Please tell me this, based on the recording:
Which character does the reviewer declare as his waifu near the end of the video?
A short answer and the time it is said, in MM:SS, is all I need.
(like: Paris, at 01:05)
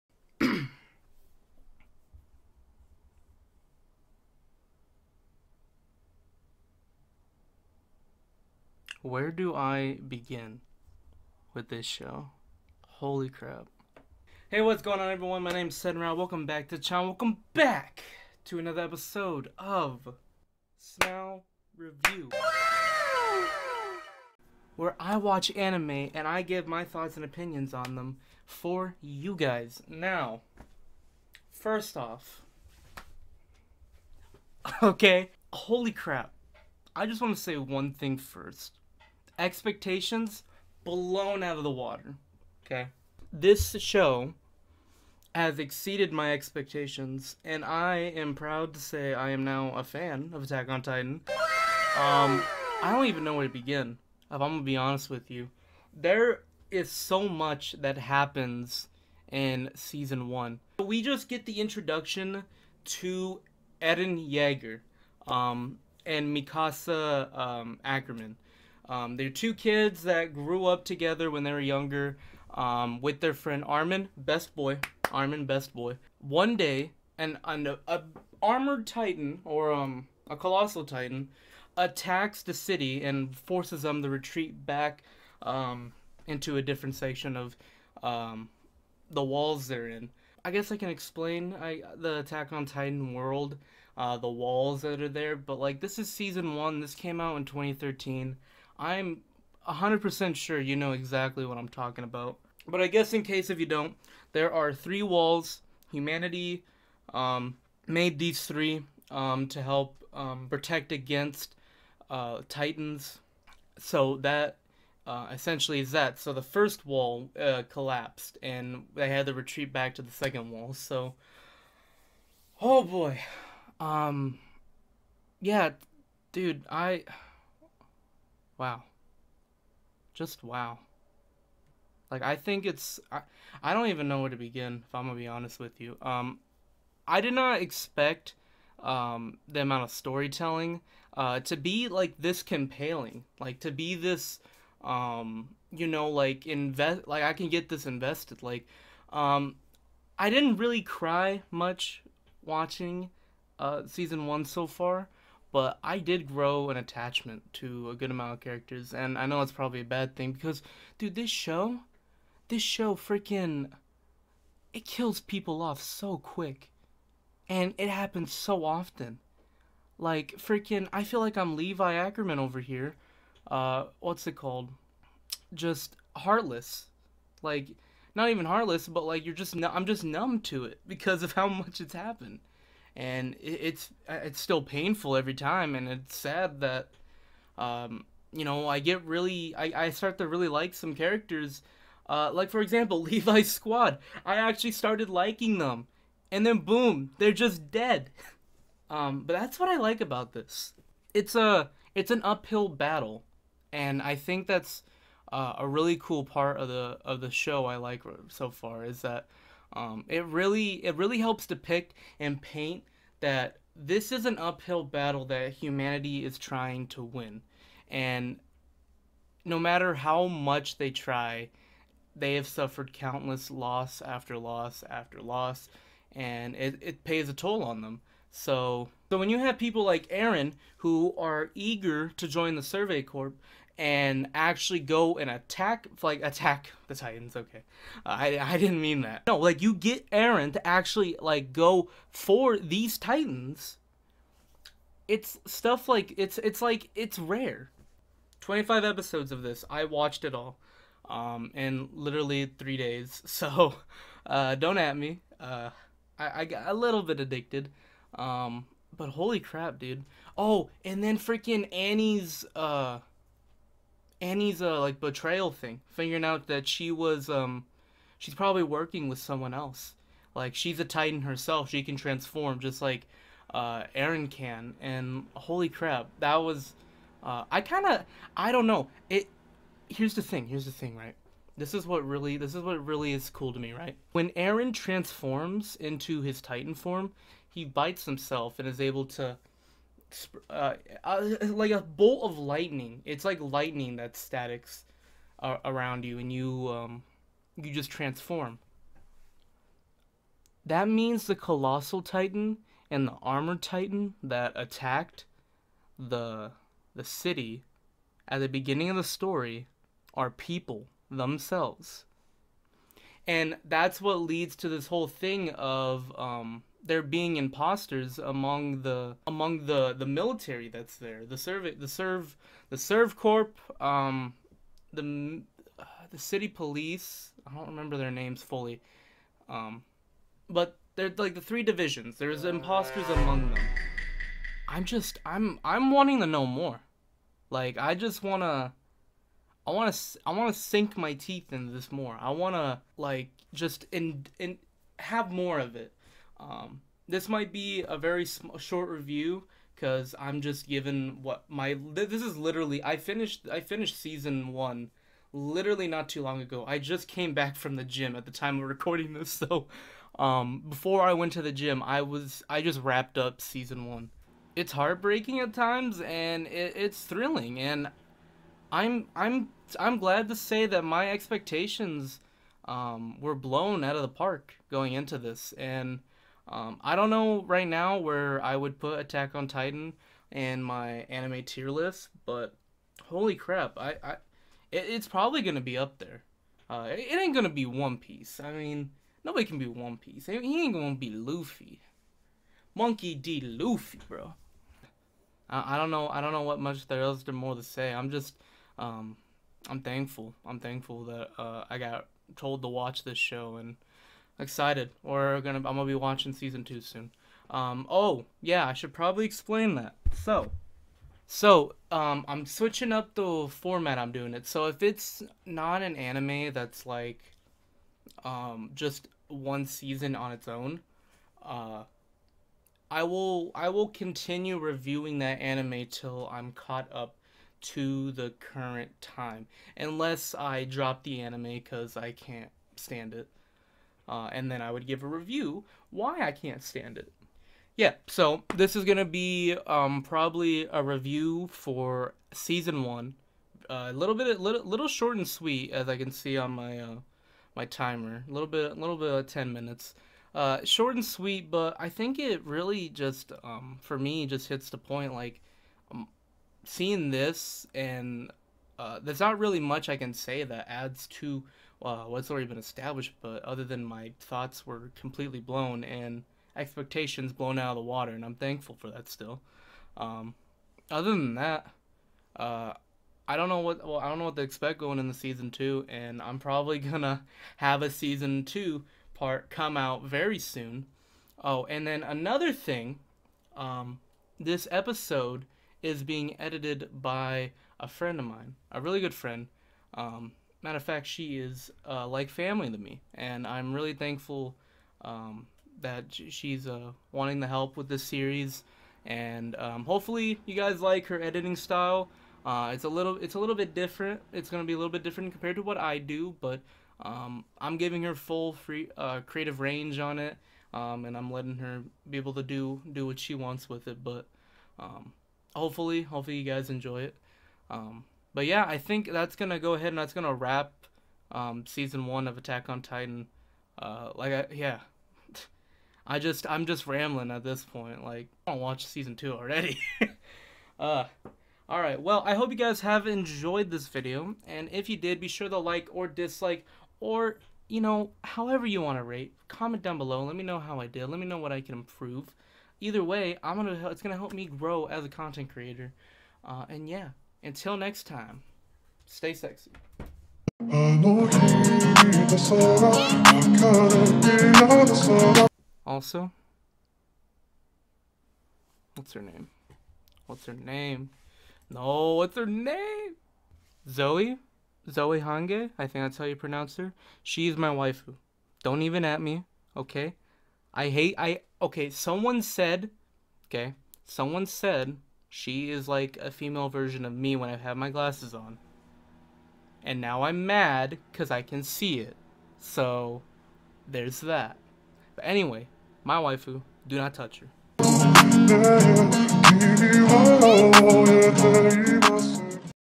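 Zoe Hange, at 09:24.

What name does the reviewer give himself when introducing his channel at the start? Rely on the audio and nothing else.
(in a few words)
Senrab.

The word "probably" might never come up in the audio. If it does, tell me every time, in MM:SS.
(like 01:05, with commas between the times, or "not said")
02:39, 04:28, 06:25, 06:48, 07:20, 07:56.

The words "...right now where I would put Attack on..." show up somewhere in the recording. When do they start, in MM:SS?
06:17.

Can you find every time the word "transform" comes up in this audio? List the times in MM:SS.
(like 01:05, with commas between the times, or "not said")
04:31, 04:44, 04:57.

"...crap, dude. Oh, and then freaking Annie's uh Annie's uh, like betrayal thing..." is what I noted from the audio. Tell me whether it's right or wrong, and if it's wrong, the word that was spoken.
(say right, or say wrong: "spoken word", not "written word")
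right.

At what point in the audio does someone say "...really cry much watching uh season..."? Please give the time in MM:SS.
02:30.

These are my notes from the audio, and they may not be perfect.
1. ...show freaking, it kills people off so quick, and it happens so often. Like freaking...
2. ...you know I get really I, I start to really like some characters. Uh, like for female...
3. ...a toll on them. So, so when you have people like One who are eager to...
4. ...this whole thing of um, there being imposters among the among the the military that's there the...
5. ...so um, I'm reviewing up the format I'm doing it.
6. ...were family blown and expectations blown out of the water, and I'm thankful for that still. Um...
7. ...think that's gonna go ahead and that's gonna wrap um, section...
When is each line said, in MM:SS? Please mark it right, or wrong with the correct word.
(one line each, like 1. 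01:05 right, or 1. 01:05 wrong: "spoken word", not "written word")
1. 02:42 right
2. 03:08 wrong: "example", not "female"
3. 03:47 wrong: "Eren", not "One"
4. 05:14 right
5. 06:51 wrong: "switching", not "reviewing"
6. 07:44 wrong: "completely", not "family"
7. 08:38 wrong: "season", not "section".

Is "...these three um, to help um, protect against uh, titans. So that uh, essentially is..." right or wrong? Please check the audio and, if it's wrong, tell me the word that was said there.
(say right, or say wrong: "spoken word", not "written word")
right.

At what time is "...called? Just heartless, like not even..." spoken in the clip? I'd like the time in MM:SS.
02:54.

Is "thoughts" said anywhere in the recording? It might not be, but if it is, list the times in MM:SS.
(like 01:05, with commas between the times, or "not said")
00:26, 07:44.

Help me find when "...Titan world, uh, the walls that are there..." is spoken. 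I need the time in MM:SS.
01:32.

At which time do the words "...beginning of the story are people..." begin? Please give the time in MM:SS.
05:08.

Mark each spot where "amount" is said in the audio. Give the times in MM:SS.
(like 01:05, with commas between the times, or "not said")
02:19, 02:38.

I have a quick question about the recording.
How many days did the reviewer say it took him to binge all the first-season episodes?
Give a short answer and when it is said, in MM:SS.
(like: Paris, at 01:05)
3, at 04:12.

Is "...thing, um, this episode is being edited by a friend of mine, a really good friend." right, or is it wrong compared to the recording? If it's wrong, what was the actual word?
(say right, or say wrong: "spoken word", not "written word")
right.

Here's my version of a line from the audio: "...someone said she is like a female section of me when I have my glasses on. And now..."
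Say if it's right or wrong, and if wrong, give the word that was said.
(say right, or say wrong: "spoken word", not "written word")
wrong: "version", not "section".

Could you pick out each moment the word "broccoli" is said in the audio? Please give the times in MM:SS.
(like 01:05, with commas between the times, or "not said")
not said.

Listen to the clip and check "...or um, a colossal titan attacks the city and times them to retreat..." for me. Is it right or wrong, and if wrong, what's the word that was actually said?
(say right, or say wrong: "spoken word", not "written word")
wrong: "forces", not "times".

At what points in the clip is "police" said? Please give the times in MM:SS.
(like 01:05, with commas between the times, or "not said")
05:26.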